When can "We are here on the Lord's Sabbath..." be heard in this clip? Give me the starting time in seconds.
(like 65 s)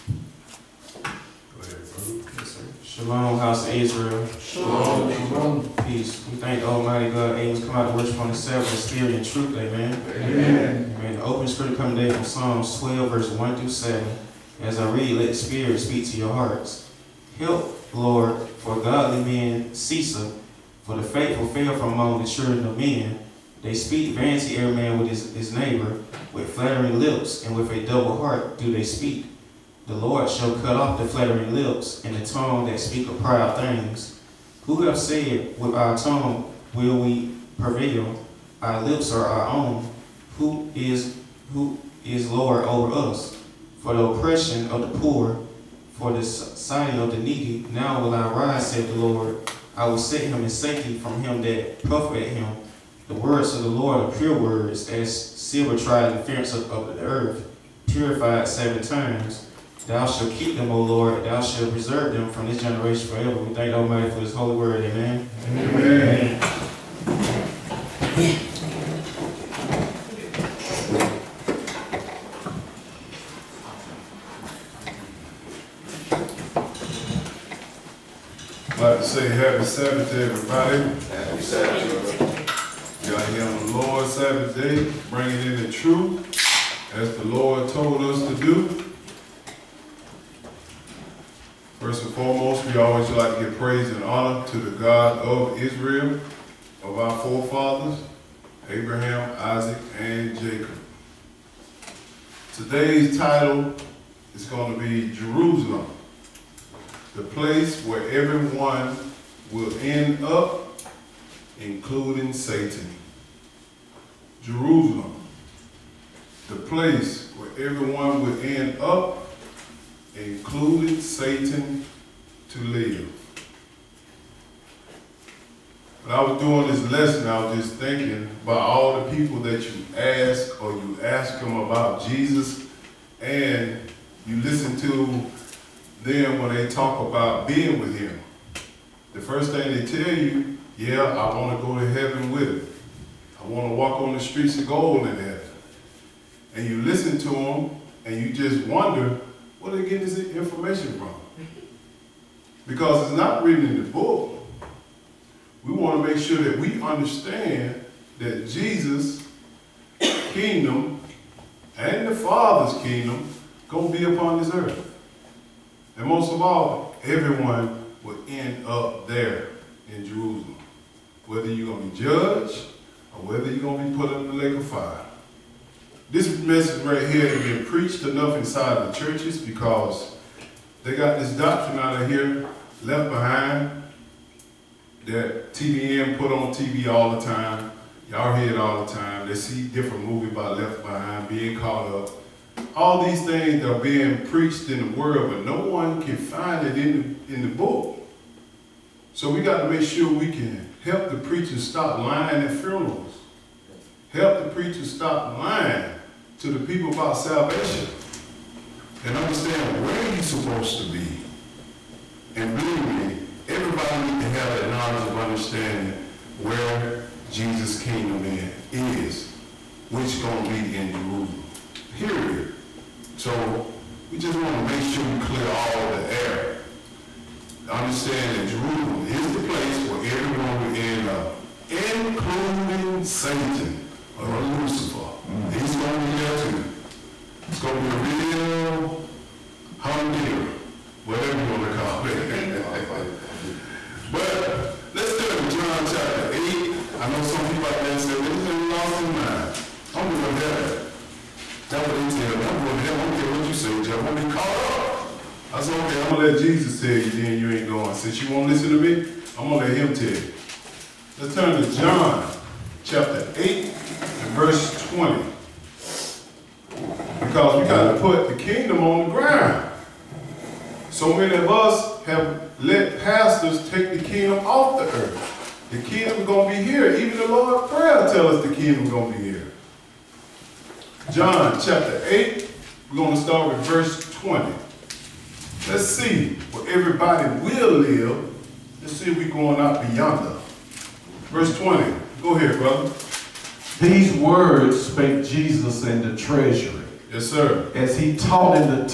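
83 s.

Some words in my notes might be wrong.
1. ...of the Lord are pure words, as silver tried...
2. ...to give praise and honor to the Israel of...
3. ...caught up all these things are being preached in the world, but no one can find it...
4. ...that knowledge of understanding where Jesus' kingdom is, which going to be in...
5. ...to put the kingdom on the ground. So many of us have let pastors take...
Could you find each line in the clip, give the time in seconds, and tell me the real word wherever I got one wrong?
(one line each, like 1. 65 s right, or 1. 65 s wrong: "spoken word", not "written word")
1. 53 s right
2. 93 s wrong: "God", not "Israel"
3. 191 s right
4. 214 s right
5. 267 s right.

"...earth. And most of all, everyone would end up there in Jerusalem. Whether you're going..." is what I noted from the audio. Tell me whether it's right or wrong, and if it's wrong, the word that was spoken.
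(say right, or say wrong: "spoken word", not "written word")
right.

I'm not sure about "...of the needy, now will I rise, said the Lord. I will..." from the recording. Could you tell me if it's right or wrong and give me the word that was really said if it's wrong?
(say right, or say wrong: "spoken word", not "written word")
right.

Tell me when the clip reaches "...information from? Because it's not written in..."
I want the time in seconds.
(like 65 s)
150 s.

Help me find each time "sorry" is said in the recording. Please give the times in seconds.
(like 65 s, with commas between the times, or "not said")
not said.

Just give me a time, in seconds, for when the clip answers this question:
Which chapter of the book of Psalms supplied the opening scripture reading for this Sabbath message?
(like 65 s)
12 s.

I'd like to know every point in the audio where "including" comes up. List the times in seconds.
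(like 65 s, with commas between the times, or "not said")
111 s, 120 s, 231 s.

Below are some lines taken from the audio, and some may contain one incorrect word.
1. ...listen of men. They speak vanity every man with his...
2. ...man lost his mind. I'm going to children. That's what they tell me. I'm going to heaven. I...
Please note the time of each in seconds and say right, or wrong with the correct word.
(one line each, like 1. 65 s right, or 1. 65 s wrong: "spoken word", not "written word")
1. 22 s wrong: "children", not "listen"
2. 248 s wrong: "heaven", not "children".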